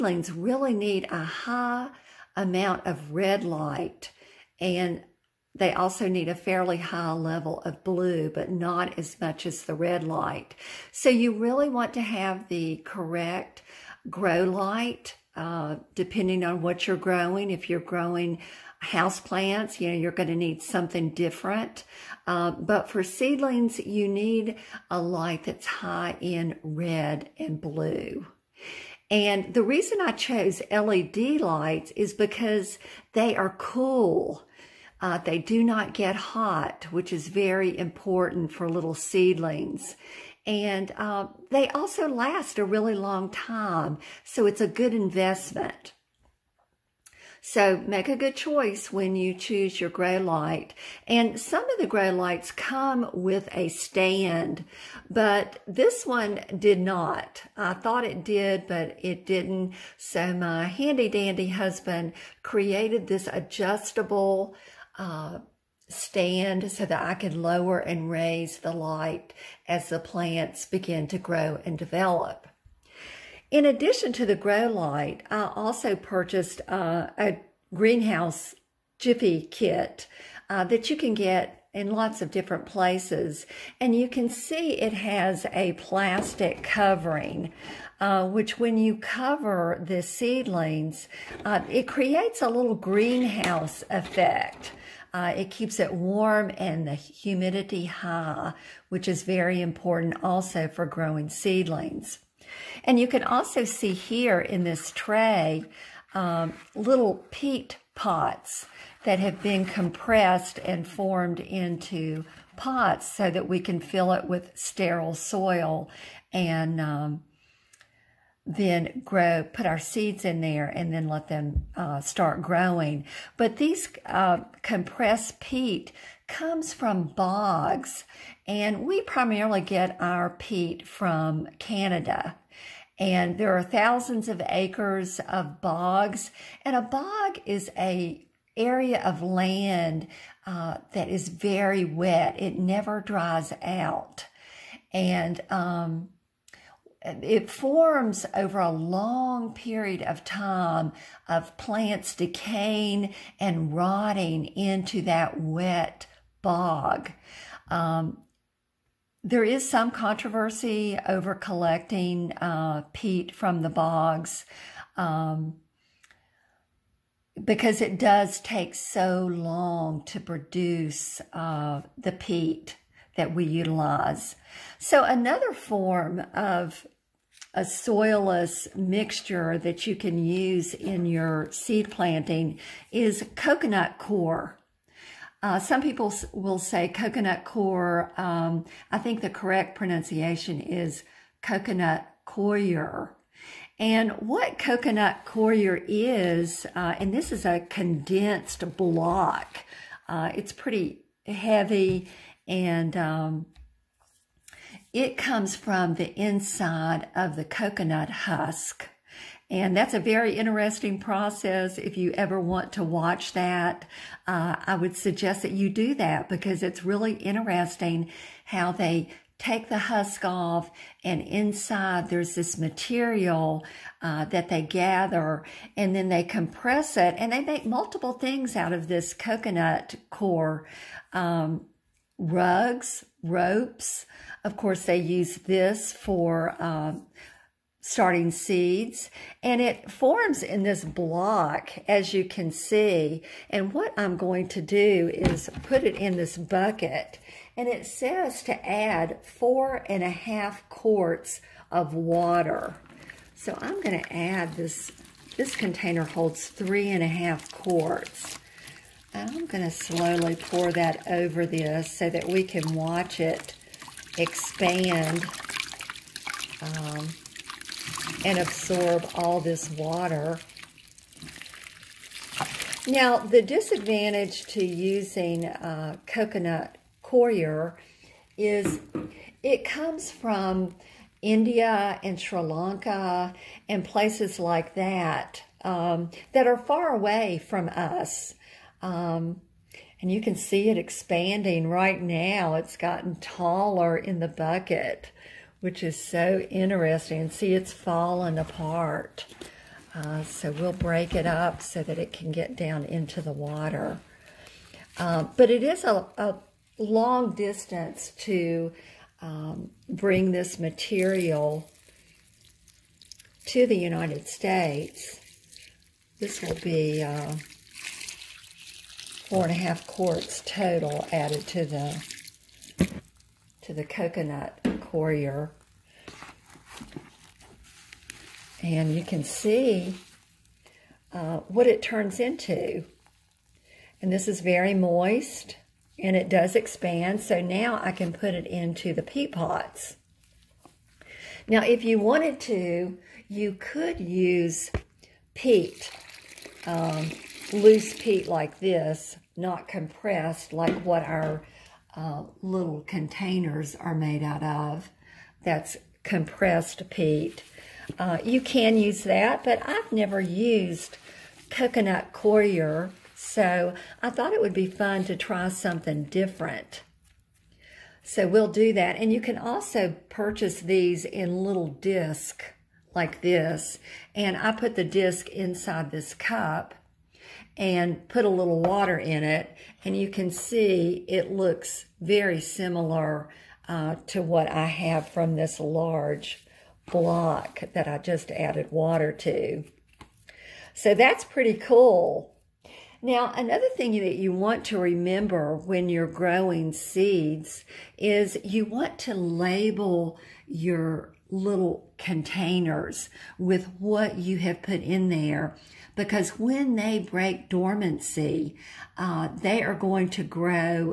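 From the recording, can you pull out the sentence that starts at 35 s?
Uh, they do not get hot, which is very important for little seedlings.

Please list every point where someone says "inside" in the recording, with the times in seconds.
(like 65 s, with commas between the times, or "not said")
206 s, 221 s, 375 s.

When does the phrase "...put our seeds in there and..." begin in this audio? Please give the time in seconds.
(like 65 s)
119 s.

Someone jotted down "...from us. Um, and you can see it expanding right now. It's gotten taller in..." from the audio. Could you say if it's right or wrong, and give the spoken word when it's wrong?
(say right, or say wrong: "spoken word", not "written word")
right.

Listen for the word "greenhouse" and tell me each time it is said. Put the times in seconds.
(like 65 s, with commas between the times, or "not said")
77 s, 92 s.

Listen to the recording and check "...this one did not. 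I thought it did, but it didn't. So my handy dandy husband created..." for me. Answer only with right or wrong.
right.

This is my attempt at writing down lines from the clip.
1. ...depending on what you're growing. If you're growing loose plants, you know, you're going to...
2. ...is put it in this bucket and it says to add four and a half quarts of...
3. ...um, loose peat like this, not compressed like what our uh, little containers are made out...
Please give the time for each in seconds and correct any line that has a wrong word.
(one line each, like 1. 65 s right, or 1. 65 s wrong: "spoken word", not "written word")
1. 15 s wrong: "house", not "loose"
2. 245 s right
3. 346 s right.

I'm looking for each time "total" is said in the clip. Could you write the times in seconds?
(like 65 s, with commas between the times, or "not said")
320 s.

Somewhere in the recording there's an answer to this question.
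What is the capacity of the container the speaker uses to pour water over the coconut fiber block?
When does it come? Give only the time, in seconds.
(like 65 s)
256 s.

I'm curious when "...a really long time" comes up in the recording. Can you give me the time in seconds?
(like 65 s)
42 s.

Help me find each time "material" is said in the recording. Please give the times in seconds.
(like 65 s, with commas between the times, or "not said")
222 s, 310 s.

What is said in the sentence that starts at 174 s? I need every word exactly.
So another form of a soilless mixture that you can use in your seed planting is coconut core.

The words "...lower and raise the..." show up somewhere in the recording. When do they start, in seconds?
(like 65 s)
67 s.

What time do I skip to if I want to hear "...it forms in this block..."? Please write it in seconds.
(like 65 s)
239 s.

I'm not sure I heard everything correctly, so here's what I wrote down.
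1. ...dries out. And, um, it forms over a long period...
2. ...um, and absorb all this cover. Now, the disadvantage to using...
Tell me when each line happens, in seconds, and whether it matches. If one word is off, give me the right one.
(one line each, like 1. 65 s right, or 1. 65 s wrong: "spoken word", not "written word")
1. 142 s right
2. 266 s wrong: "water", not "cover".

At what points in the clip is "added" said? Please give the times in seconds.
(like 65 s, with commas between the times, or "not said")
321 s, 388 s.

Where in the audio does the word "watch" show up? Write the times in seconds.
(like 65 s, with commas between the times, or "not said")
212 s, 262 s.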